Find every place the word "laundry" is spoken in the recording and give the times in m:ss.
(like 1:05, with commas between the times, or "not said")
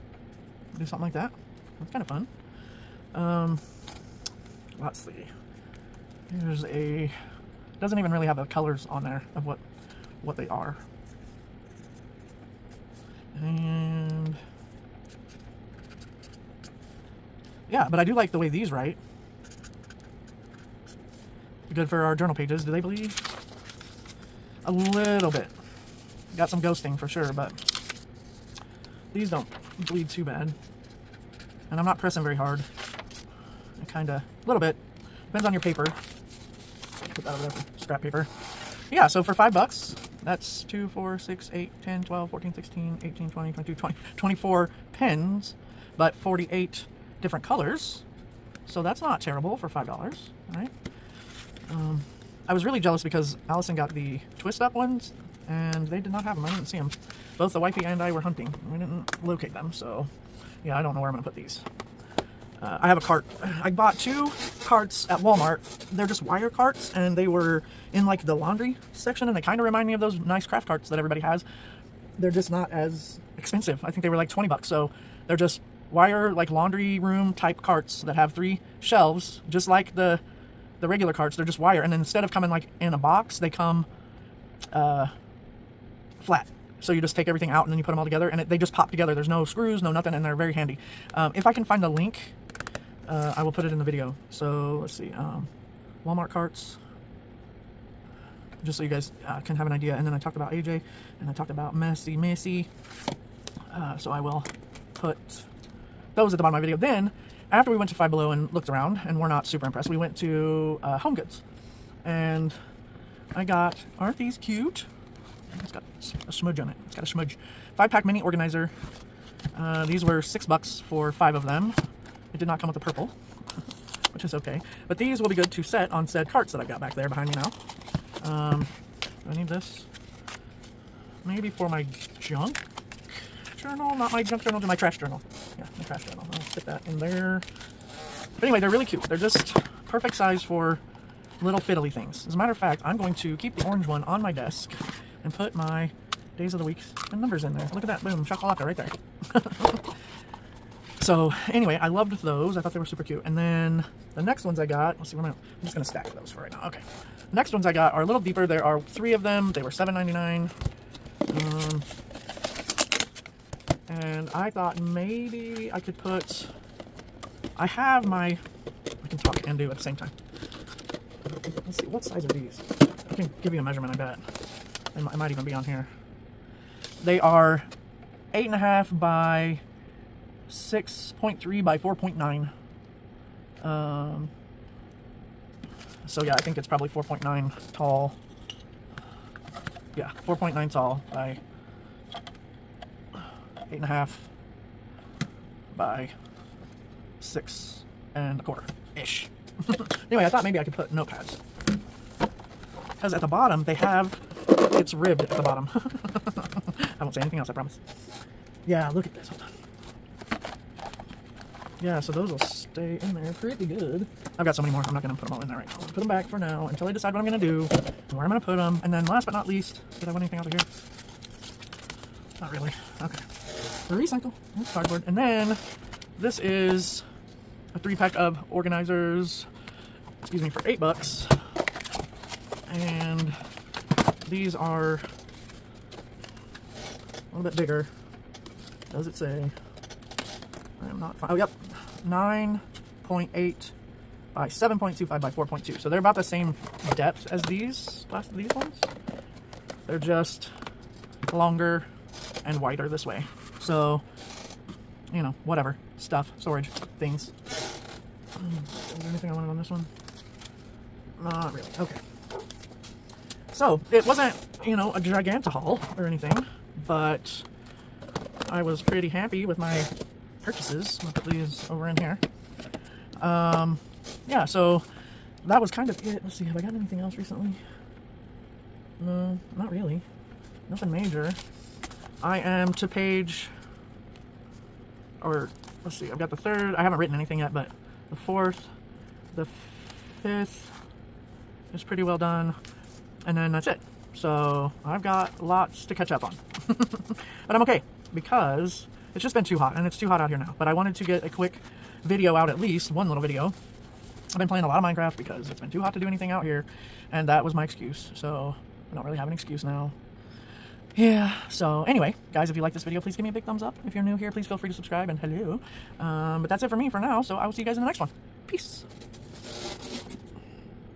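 1:08, 1:16.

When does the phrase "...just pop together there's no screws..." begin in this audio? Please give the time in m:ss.
1:28.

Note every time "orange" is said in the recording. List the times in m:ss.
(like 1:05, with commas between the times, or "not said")
2:23.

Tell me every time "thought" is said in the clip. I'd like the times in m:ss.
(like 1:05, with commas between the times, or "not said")
2:32, 2:44, 3:20.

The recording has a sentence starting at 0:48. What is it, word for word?
So that's not terrible for $5, all right?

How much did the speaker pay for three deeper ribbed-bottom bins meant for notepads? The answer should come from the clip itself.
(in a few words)
$7.99.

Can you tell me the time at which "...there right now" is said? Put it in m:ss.
3:35.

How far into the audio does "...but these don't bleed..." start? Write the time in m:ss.
0:27.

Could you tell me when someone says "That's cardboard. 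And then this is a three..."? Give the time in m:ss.
3:44.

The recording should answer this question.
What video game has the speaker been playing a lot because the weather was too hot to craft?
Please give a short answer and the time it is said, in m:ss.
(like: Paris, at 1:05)
Minecraft, at 5:04.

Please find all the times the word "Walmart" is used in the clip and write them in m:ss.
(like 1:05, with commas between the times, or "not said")
1:05, 1:36.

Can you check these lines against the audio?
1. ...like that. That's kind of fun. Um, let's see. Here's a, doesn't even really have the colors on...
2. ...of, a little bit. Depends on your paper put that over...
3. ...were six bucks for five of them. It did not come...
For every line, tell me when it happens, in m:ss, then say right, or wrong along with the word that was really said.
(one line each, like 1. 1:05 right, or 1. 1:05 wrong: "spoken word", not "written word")
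1. 0:01 right
2. 0:34 right
3. 2:00 right.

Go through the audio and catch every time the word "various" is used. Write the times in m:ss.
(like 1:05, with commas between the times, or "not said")
not said.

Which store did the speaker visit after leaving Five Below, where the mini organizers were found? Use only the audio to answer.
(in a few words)
Home Goods.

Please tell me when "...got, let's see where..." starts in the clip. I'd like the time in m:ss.
2:34.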